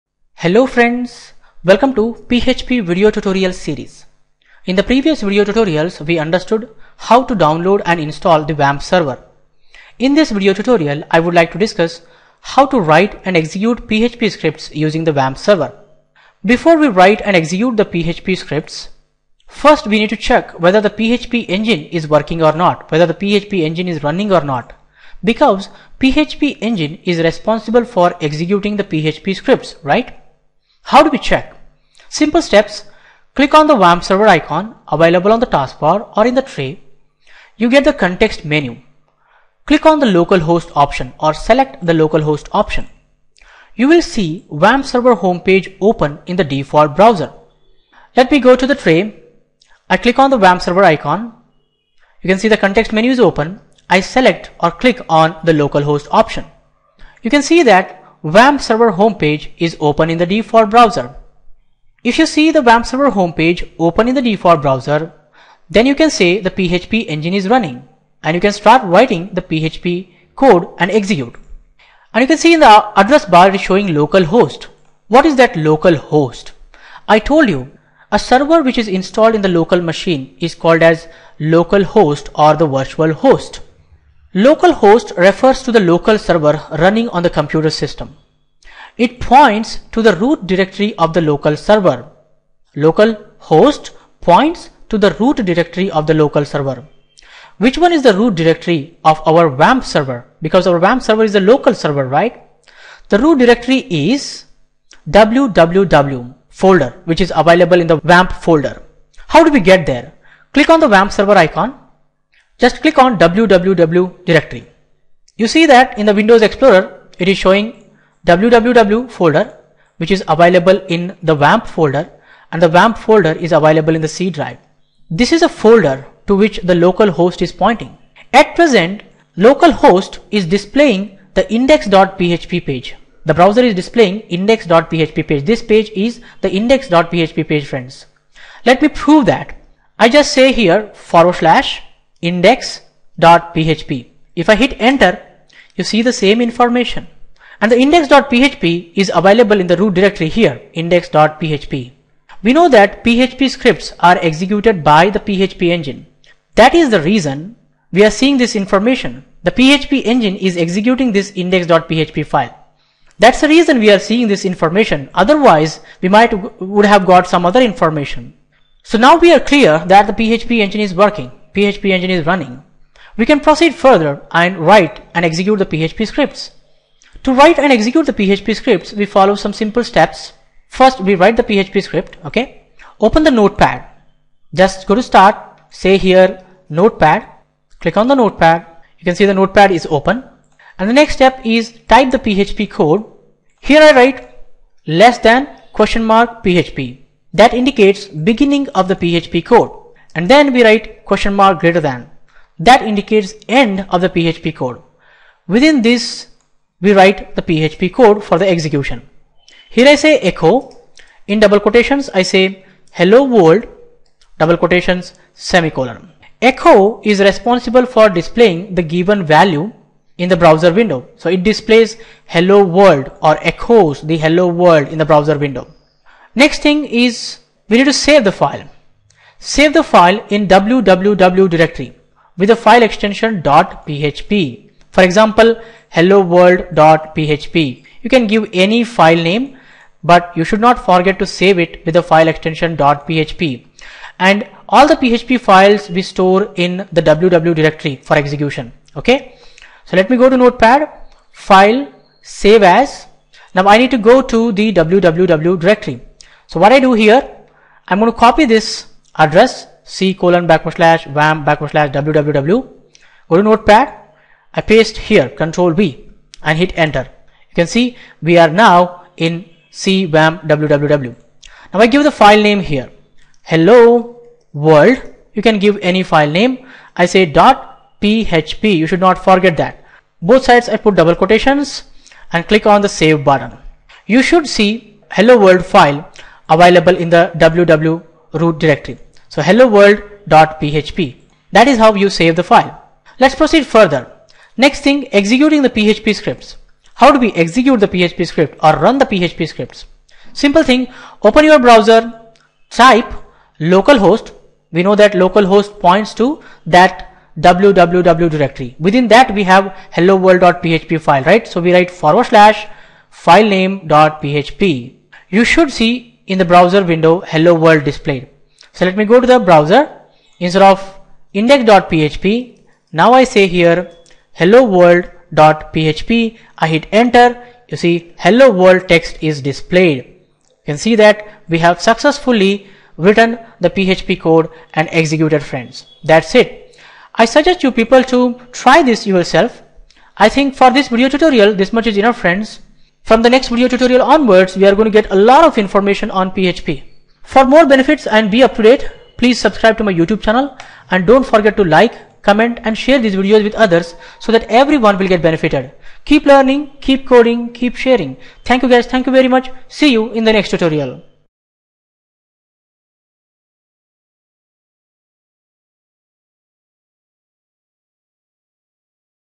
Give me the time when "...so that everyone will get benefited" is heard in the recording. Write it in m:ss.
5:54.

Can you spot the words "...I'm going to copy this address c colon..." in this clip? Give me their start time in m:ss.
4:17.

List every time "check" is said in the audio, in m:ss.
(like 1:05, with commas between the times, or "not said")
0:20, 0:31.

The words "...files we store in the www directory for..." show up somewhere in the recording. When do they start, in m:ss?
4:05.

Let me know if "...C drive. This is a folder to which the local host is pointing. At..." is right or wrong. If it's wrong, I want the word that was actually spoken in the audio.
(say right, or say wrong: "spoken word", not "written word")
right.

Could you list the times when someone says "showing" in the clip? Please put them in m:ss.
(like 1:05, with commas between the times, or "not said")
1:13, 1:57.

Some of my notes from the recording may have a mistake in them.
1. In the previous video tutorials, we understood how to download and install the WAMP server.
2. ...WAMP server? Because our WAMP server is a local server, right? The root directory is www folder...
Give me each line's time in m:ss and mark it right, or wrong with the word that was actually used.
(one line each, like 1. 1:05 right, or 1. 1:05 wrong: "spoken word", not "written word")
1. 0:04 right
2. 1:39 right.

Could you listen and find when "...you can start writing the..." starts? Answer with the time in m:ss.
1:08.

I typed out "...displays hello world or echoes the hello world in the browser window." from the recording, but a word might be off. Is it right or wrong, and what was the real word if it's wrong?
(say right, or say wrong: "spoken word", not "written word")
right.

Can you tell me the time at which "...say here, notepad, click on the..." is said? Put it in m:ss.
3:05.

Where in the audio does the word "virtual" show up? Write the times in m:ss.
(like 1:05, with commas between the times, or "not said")
1:22.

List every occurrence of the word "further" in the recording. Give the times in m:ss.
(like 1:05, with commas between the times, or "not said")
2:53, 4:53.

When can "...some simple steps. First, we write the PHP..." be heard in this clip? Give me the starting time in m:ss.
2:59.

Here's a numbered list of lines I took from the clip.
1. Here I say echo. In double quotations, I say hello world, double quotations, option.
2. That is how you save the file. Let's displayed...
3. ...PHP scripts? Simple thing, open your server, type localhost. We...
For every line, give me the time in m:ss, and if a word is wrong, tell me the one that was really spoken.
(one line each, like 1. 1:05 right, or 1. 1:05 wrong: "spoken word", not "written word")
1. 3:29 wrong: "semicolon", not "option"
2. 4:51 wrong: "proceed", not "displayed"
3. 4:59 wrong: "browser", not "server".